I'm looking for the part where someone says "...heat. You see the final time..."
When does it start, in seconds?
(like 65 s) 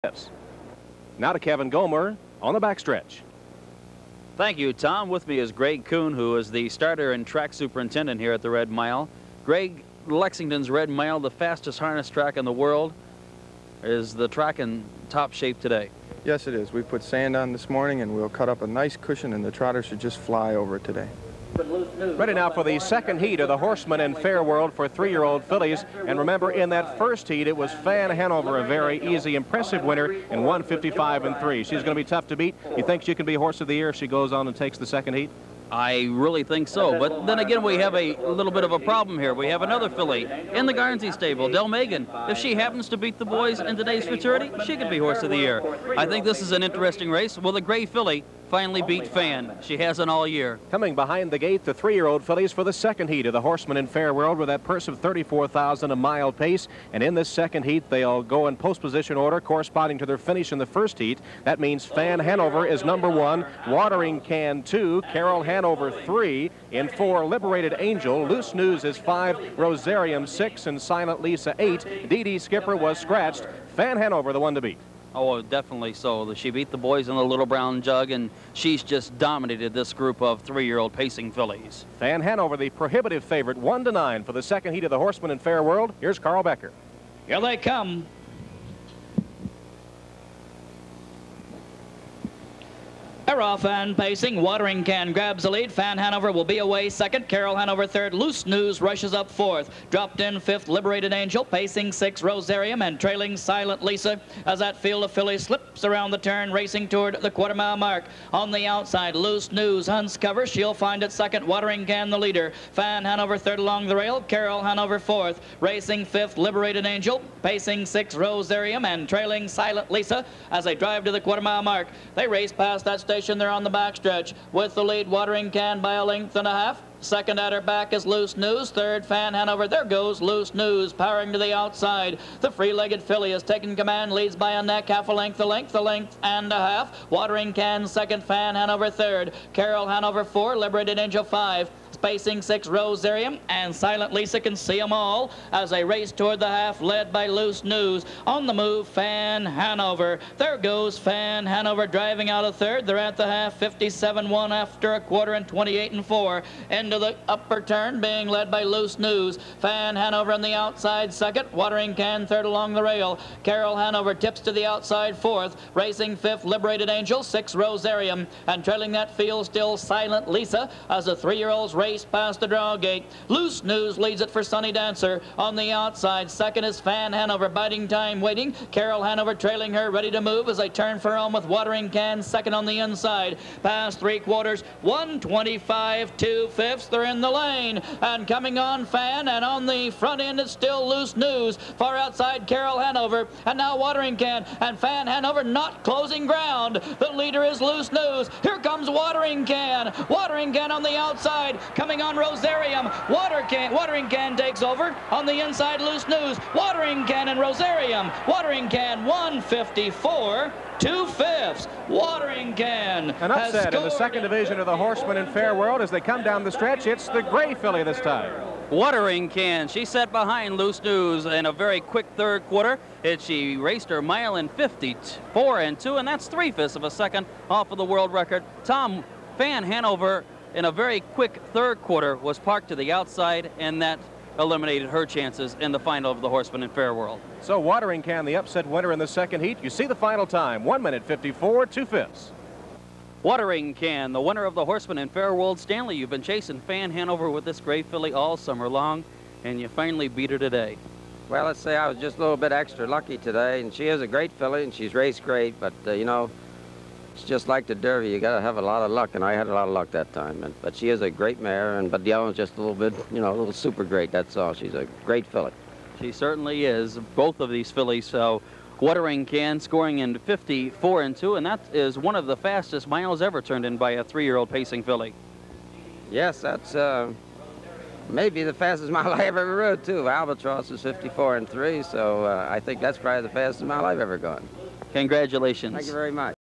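239 s.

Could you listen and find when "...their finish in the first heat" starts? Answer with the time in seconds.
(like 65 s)
60 s.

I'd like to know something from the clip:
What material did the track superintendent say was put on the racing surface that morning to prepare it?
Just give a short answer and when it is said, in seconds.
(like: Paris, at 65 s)
Sand, at 17 s.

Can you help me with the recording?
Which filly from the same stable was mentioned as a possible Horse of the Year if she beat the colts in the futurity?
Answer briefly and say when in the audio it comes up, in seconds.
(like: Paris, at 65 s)
Delmegan, at 41 s.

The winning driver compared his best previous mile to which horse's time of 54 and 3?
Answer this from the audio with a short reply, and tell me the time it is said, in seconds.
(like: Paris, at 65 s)
Albatross, at 280 s.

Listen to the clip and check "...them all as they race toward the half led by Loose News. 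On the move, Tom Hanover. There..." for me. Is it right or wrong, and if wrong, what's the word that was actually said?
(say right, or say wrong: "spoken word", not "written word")
wrong: "Fan", not "Tom".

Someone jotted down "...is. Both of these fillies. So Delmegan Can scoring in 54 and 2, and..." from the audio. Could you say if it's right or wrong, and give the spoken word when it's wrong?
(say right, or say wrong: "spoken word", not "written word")
wrong: "Watering", not "Delmegan".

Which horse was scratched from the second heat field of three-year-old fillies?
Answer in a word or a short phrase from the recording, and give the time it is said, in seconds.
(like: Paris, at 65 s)
Dee Dee Skipper, at 72 s.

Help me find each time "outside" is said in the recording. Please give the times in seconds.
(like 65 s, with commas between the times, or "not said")
108 s, 131 s, 160 s, 164 s, 175 s, 191 s, 200 s, 232 s.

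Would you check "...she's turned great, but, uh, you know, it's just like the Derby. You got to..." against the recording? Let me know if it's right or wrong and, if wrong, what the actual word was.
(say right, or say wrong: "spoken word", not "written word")
wrong: "raced", not "turned".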